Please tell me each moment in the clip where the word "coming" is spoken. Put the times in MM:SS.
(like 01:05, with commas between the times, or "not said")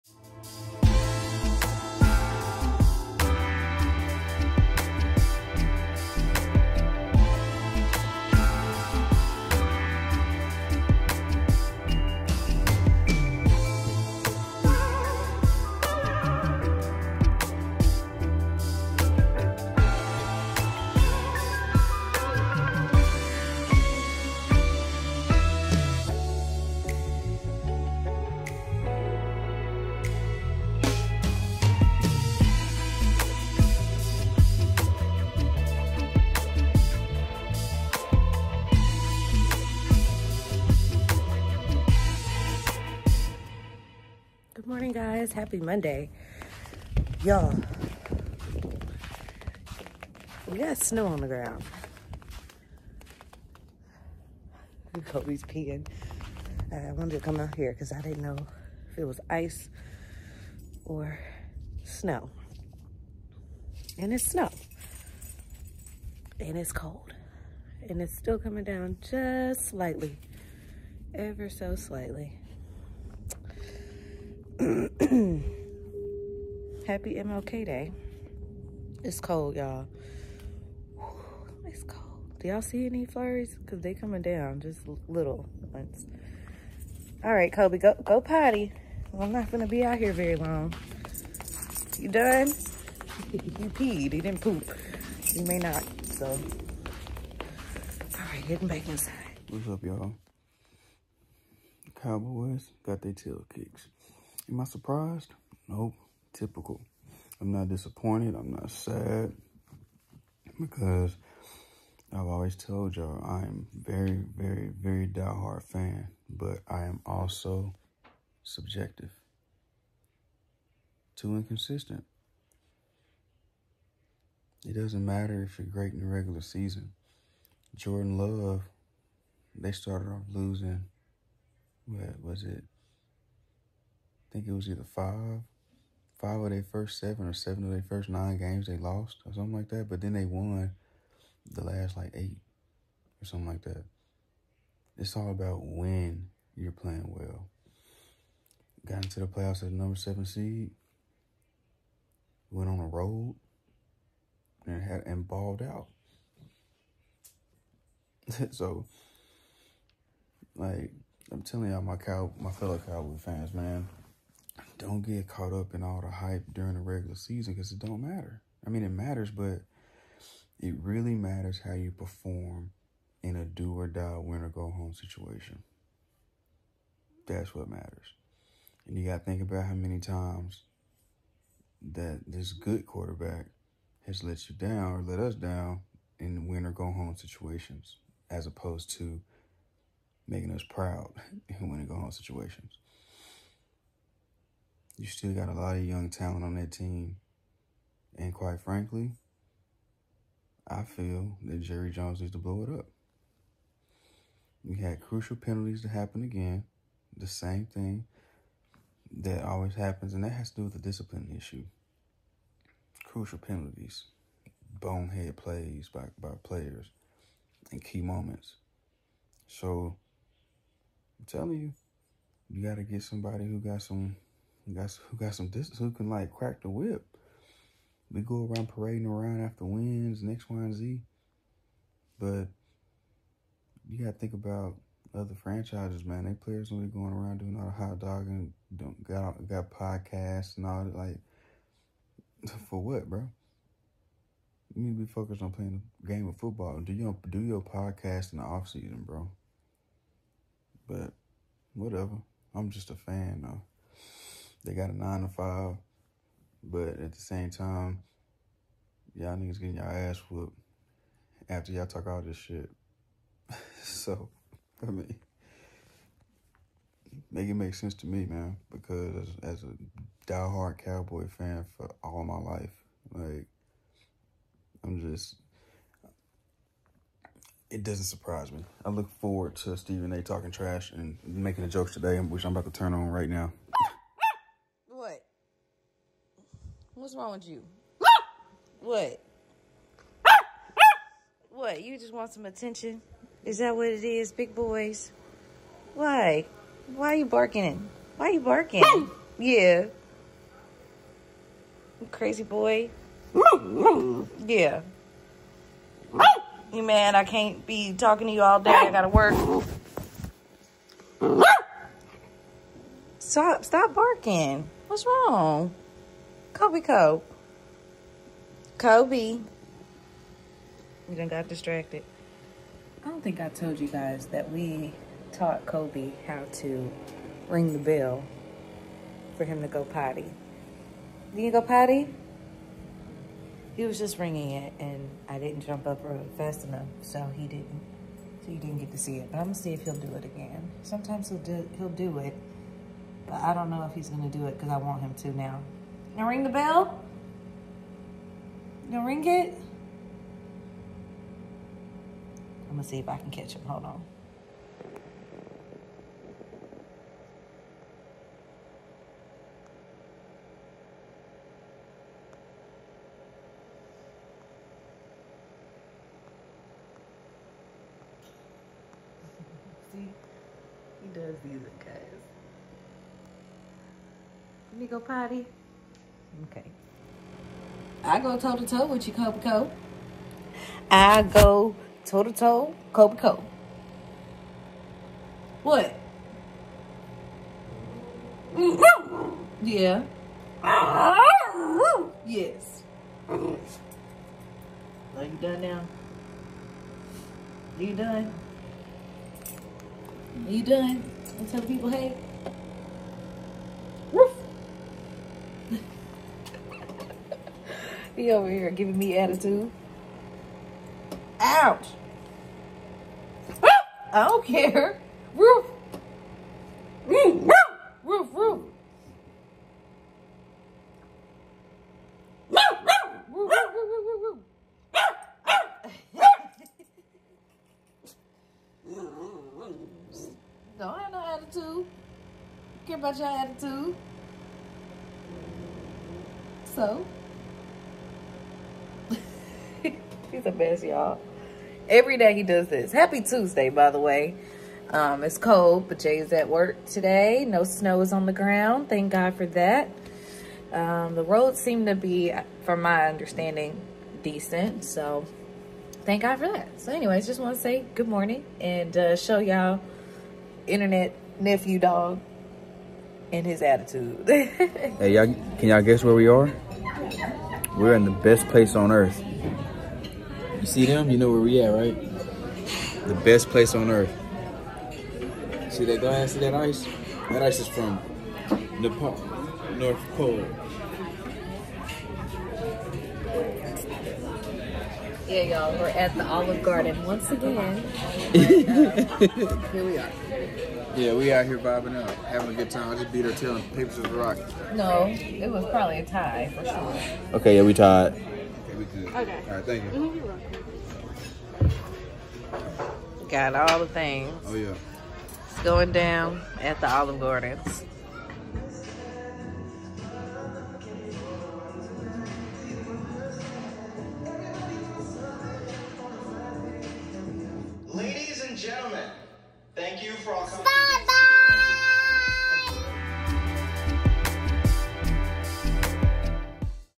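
01:08, 01:23.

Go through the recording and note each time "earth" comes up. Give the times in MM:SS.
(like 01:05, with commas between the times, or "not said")
07:48, 07:53.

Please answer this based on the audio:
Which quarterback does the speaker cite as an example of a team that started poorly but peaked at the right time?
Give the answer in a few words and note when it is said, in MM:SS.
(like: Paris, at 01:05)
Jordan Love, at 02:07.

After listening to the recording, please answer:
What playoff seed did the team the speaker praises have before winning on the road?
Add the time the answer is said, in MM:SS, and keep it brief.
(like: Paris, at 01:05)
7, at 02:29.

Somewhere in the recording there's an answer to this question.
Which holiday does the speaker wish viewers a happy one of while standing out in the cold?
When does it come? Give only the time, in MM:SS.
01:16.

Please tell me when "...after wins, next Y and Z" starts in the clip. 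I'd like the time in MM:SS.
03:49.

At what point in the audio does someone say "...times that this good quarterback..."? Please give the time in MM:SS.
02:59.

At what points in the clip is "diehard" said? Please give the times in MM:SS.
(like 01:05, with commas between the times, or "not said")
01:55, 04:30.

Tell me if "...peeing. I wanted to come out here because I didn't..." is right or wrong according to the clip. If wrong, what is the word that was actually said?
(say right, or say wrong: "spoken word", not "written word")
right.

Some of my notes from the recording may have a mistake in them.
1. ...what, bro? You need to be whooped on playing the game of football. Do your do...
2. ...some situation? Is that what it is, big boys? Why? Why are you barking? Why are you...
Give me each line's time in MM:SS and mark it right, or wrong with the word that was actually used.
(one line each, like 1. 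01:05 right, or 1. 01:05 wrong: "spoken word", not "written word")
1. 04:02 wrong: "focused", not "whooped"
2. 04:52 wrong: "attention", not "situation".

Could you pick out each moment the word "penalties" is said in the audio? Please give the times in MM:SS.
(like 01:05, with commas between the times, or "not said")
03:25, 03:33.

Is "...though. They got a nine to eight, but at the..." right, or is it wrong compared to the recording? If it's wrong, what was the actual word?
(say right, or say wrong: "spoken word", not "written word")
wrong: "five", not "eight".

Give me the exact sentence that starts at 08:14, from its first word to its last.
No, it was probably a tie for sure.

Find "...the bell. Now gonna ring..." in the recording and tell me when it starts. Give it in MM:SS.
05:46.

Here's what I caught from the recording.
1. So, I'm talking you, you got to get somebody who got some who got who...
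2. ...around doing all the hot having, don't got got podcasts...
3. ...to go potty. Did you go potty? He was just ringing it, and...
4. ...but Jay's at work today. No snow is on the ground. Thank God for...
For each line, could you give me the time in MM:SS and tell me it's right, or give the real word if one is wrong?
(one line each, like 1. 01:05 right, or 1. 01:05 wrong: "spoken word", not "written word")
1. 03:39 wrong: "telling", not "talking"
2. 03:57 wrong: "dogging", not "having"
3. 05:29 right
4. 07:25 right.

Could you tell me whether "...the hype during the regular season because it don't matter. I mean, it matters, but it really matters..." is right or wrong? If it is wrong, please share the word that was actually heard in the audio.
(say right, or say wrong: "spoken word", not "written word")
right.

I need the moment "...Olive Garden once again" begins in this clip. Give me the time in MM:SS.
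08:06.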